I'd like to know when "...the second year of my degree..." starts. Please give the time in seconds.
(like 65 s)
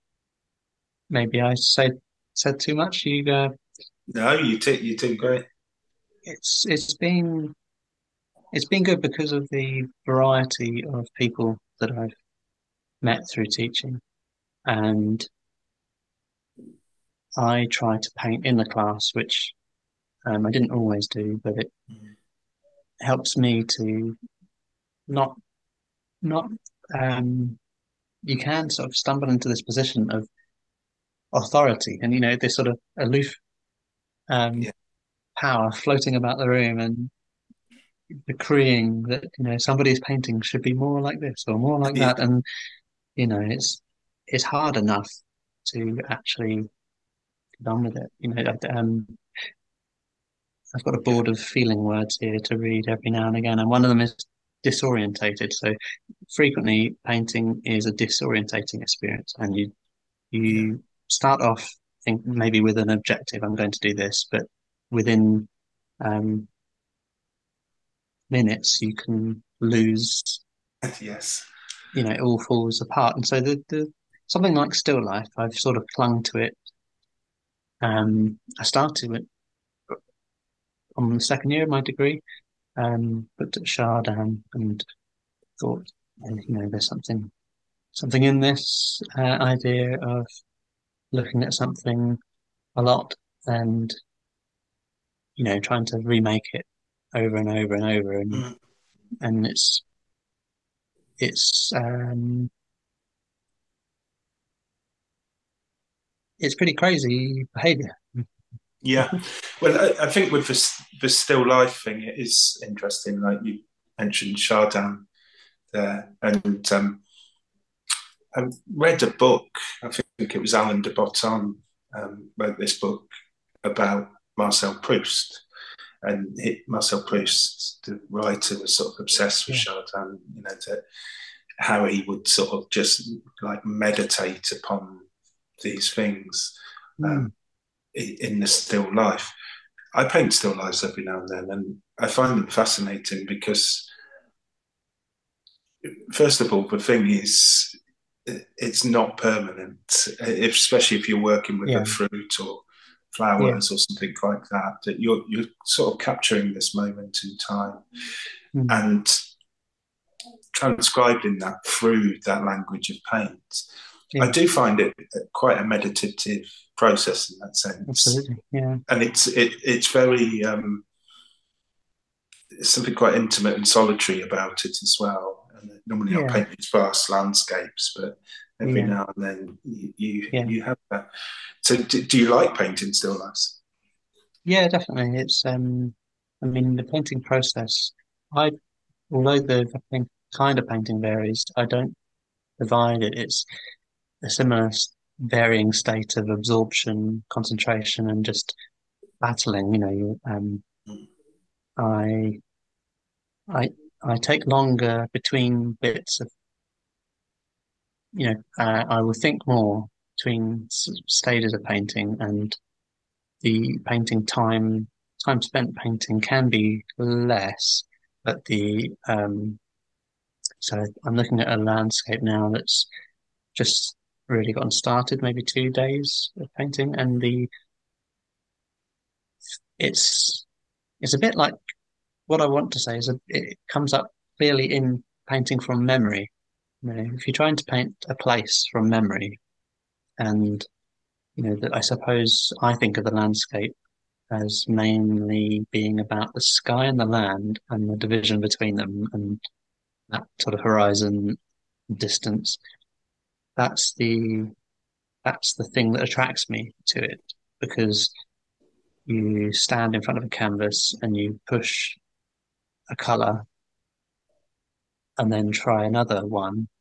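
81 s.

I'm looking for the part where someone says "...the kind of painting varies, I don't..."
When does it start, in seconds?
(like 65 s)
189 s.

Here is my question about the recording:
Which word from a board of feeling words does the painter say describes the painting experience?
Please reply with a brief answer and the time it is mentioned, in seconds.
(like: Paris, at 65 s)
Disorientated, at 54 s.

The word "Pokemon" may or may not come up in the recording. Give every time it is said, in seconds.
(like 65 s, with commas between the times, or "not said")
not said.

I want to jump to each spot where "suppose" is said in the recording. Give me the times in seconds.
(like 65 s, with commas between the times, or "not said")
241 s.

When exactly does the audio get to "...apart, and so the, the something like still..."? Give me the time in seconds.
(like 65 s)
72 s.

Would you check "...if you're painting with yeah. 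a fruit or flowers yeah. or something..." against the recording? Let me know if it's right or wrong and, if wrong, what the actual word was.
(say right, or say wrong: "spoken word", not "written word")
wrong: "working", not "painting".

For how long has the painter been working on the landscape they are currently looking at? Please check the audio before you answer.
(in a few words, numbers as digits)
2 days.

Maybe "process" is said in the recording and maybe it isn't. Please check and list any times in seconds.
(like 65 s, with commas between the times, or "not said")
166 s, 187 s.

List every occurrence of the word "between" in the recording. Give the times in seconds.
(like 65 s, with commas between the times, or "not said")
205 s, 210 s, 248 s.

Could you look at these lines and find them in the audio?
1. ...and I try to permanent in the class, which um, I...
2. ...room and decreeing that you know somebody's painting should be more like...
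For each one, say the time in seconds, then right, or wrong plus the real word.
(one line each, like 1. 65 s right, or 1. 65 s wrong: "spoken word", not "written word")
1. 14 s wrong: "paint", not "permanent"
2. 36 s right.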